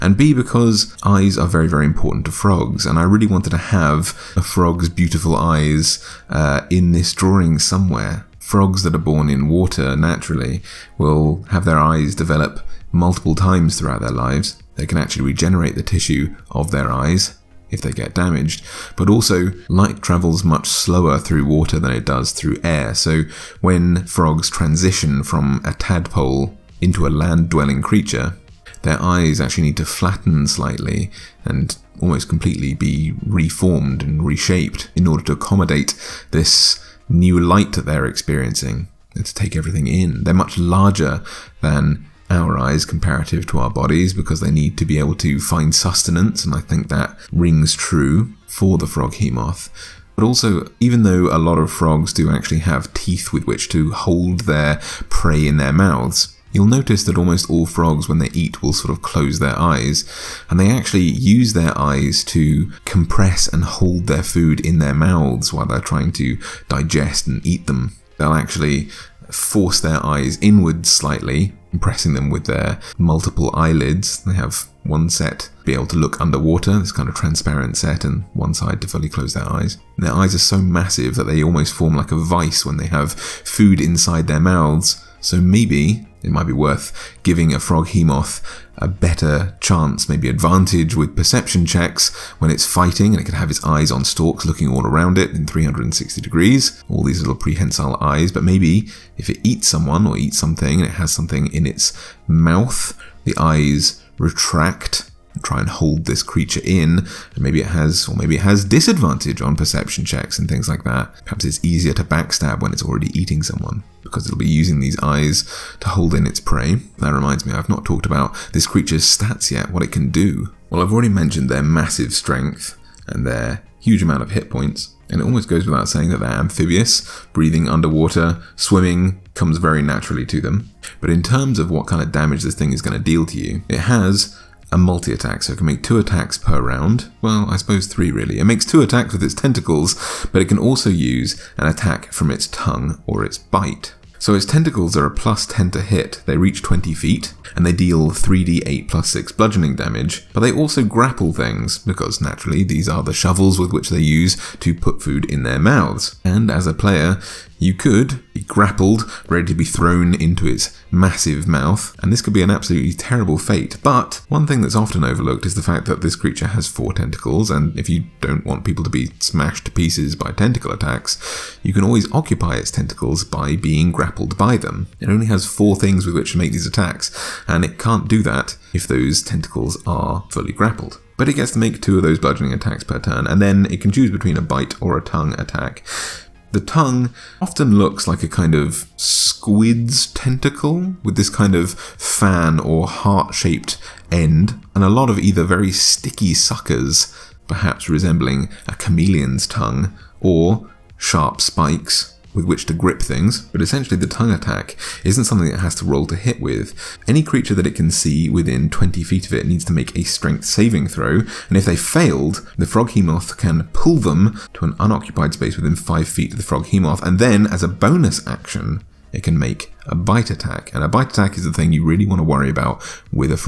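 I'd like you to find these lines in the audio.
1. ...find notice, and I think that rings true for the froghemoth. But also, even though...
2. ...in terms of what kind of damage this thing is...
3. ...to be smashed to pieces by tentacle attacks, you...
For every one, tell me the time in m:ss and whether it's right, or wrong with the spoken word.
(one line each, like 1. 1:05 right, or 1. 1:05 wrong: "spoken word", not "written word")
1. 0:45 wrong: "sustenance", not "notice"
2. 2:11 right
3. 2:48 right.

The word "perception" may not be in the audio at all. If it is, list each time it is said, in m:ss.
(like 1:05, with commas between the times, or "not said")
1:31, 1:49.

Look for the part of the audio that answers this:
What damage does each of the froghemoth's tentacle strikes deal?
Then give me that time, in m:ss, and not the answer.
2:28.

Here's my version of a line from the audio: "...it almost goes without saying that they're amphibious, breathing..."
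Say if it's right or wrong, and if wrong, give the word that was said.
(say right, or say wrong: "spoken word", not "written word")
right.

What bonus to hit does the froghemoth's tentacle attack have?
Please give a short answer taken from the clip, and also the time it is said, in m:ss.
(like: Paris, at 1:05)
+10, at 2:25.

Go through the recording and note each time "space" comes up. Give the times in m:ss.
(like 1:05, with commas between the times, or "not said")
3:35.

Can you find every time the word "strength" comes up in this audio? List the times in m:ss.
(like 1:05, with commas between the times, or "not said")
2:02, 3:30.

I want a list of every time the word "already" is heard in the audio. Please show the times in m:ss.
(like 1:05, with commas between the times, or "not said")
1:52, 2:00.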